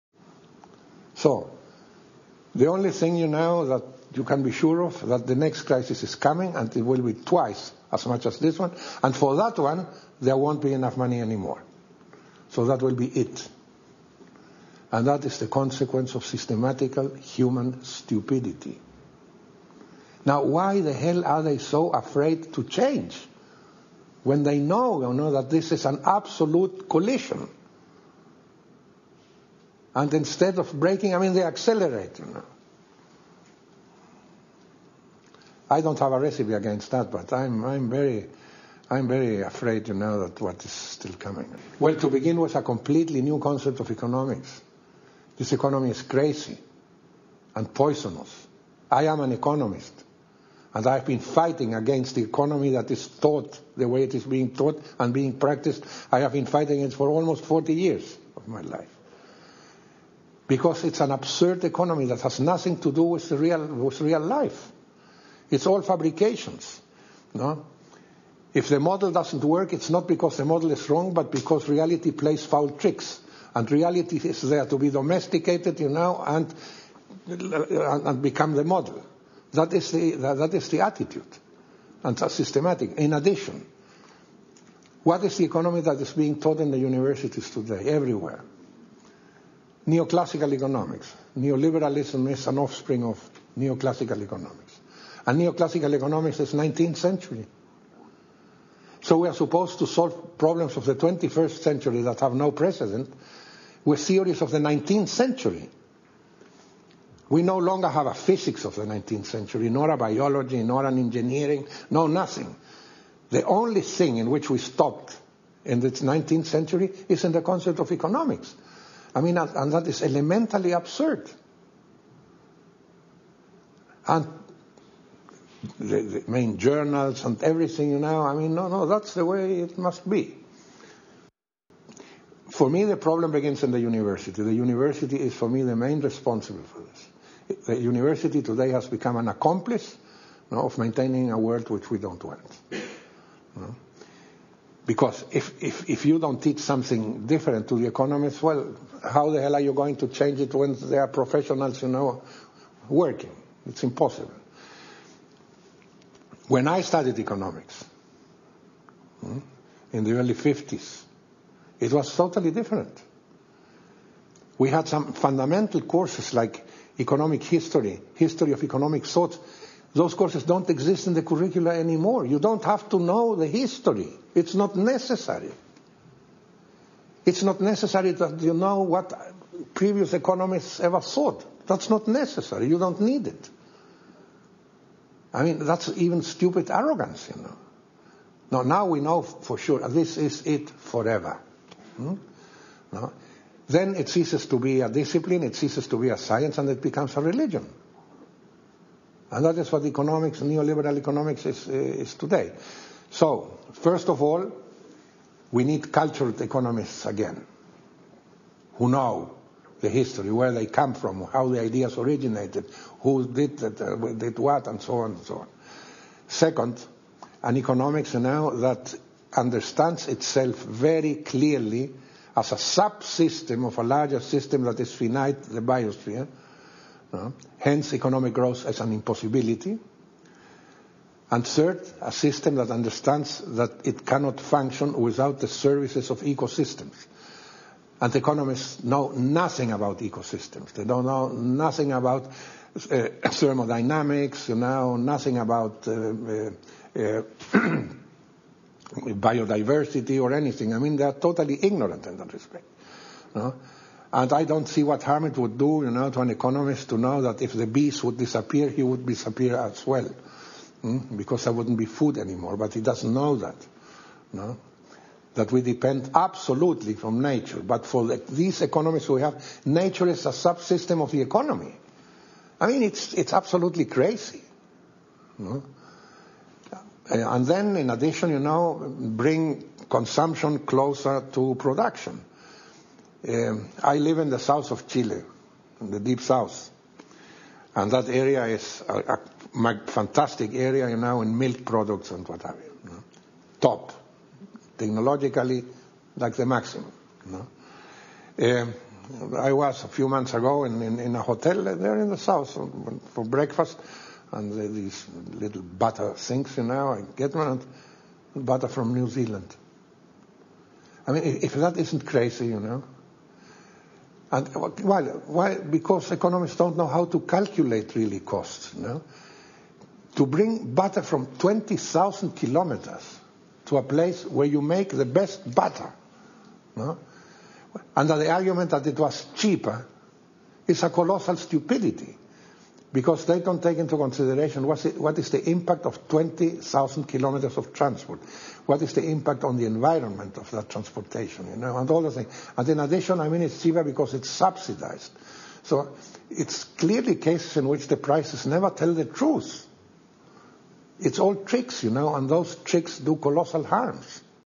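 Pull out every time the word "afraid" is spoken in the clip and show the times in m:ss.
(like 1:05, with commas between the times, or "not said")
0:21, 0:39.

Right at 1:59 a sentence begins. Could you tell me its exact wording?
I mean, and that is elementally absurd.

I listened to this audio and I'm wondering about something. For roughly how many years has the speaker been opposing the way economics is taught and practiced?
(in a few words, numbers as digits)
almost 40 years.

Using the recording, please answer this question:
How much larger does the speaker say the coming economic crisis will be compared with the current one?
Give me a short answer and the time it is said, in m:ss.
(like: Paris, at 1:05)
twice as much, at 0:07.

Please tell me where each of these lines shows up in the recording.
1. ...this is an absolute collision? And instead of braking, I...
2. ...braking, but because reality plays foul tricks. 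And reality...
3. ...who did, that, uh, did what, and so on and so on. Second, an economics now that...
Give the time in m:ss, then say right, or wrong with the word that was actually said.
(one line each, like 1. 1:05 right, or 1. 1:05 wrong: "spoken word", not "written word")
1. 0:25 right
2. 1:10 wrong: "wrong", not "braking"
3. 3:32 right.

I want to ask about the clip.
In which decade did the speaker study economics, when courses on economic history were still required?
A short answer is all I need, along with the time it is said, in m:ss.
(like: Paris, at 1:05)
early 1950s, at 2:40.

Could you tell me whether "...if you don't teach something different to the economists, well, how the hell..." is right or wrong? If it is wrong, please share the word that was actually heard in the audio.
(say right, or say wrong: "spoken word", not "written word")
right.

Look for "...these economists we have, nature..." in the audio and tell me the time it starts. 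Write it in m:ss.
4:28.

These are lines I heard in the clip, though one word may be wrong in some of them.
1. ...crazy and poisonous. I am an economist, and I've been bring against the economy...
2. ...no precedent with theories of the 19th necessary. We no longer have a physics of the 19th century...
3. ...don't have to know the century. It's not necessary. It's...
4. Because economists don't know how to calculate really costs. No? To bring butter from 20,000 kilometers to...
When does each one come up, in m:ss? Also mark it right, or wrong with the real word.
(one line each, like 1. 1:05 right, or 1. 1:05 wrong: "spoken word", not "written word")
1. 0:46 wrong: "fighting", not "bring"
2. 1:42 wrong: "century", not "necessary"
3. 2:52 wrong: "history", not "century"
4. 5:15 right.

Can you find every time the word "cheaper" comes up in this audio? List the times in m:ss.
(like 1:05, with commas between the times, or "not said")
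5:29, 5:43.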